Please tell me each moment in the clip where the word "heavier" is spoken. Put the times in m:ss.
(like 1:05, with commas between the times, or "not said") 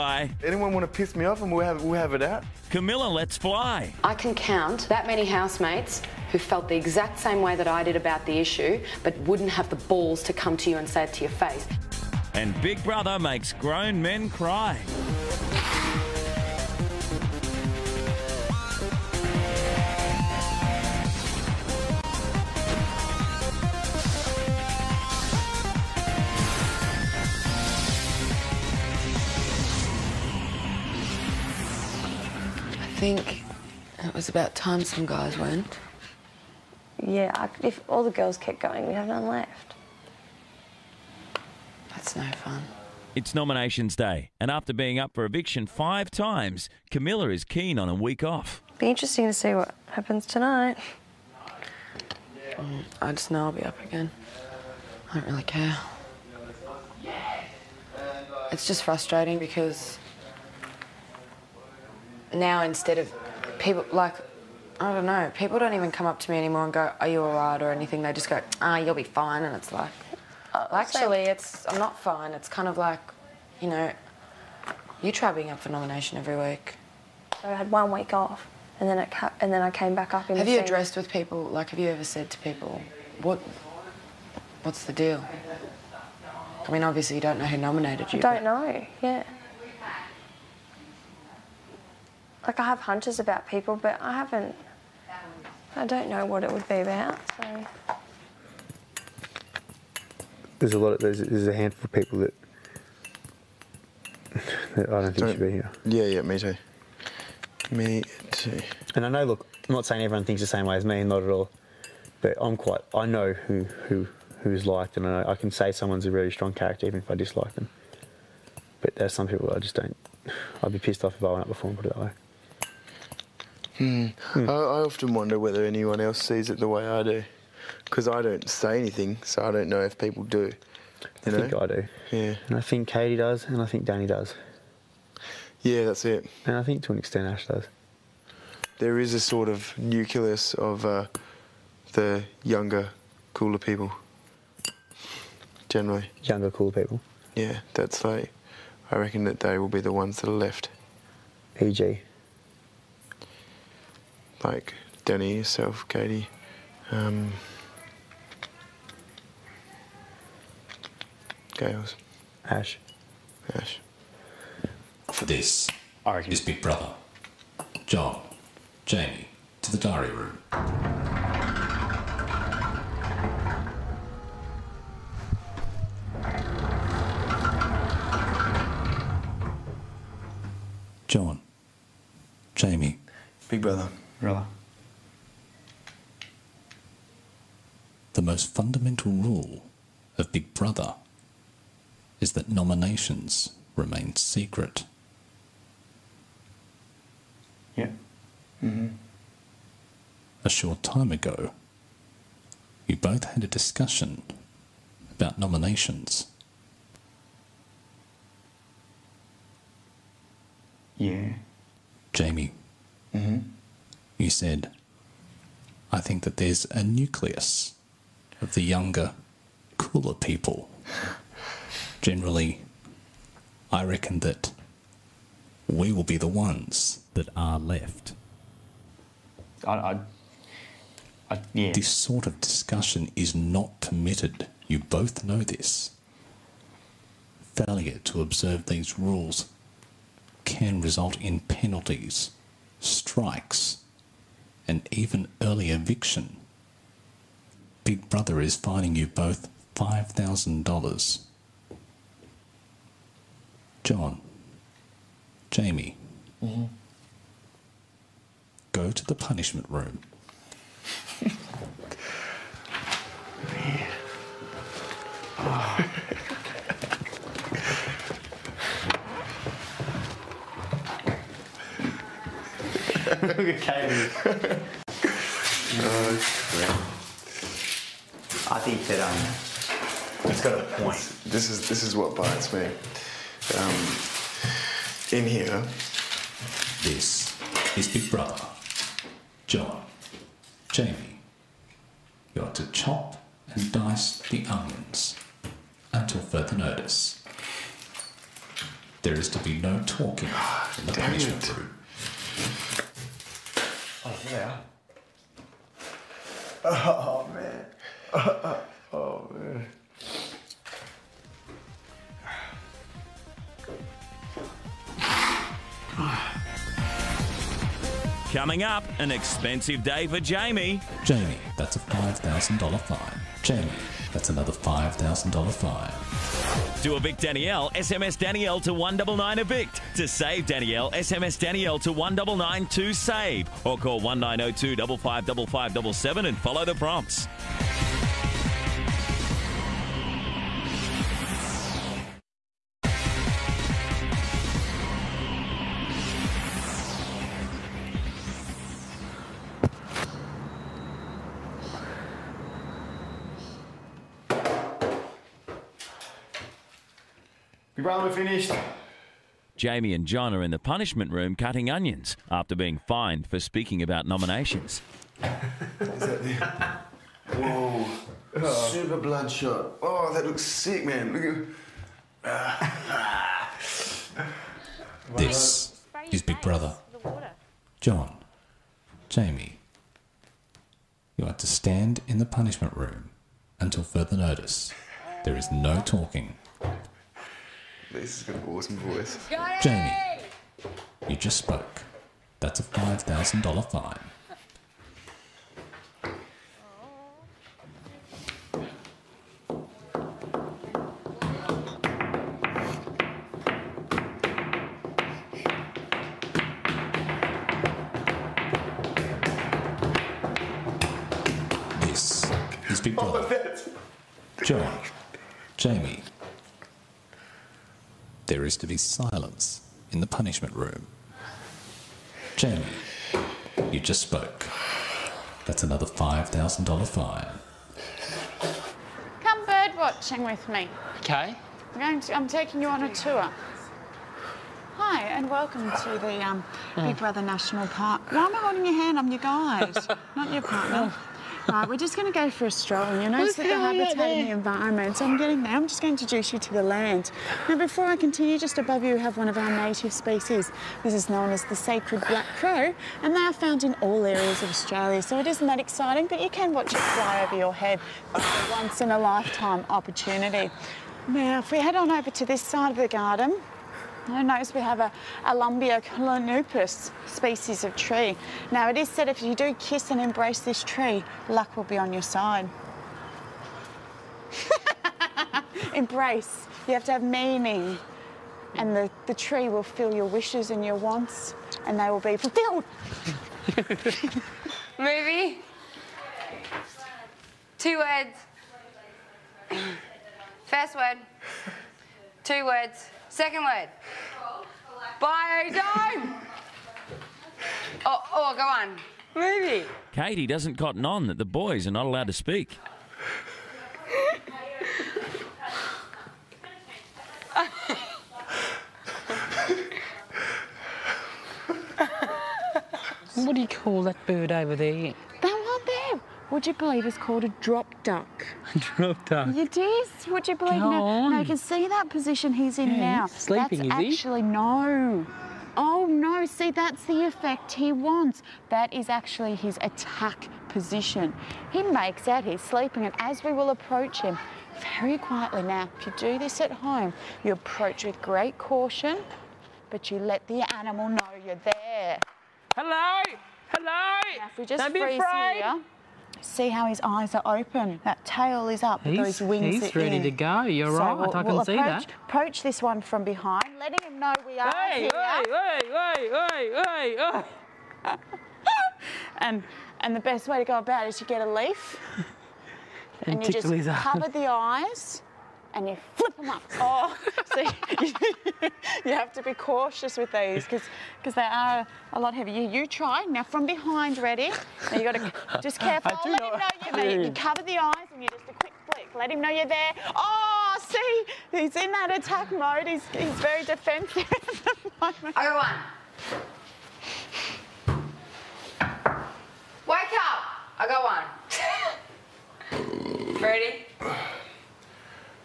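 9:32.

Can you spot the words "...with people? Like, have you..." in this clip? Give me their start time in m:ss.
1:20.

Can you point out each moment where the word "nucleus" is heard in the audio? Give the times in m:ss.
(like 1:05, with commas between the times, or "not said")
2:19, 3:36.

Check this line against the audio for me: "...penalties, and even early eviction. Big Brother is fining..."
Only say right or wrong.
wrong.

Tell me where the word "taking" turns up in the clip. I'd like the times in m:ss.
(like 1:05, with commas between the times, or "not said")
7:12.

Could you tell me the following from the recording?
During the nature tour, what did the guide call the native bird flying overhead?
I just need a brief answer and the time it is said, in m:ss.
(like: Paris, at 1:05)
Sacred black crow, at 7:31.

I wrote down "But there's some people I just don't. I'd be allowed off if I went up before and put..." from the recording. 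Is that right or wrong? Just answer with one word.
wrong.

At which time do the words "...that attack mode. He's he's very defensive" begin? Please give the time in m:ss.
9:41.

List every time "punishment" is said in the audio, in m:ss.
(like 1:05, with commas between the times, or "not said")
4:19, 5:01, 6:00, 6:22, 7:00.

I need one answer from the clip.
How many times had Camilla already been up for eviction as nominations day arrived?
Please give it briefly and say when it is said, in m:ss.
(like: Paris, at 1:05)
5, at 0:45.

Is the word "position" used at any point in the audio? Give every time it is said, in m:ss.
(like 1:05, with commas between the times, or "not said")
8:41, 8:50.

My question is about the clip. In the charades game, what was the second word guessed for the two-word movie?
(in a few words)
Biodome.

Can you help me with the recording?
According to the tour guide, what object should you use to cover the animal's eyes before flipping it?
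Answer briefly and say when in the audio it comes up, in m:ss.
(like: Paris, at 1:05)
A leaf, at 9:21.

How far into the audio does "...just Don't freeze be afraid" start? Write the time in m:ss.
9:04.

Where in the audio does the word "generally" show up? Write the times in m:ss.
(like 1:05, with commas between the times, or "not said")
2:25, 3:42.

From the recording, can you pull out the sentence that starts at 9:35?
Oh, let him know you're there.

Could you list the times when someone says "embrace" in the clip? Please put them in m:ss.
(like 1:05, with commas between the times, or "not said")
7:49, 7:55.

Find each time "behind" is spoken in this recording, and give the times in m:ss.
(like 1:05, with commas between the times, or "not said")
9:13, 9:33.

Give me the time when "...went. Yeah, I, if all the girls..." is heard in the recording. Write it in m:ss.
0:35.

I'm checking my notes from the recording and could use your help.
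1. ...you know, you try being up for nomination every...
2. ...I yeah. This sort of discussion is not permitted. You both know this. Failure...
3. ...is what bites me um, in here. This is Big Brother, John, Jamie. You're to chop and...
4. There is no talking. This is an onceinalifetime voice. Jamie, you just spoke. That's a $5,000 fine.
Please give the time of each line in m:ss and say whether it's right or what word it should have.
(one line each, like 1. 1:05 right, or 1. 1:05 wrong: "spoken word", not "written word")
1. 1:13 right
2. 3:51 right
3. 4:41 right
4. 6:25 wrong: "awesome", not "onceinalifetime".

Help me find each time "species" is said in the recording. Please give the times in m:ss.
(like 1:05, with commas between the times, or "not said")
7:29, 7:47.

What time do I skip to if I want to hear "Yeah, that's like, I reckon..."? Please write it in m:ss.
2:27.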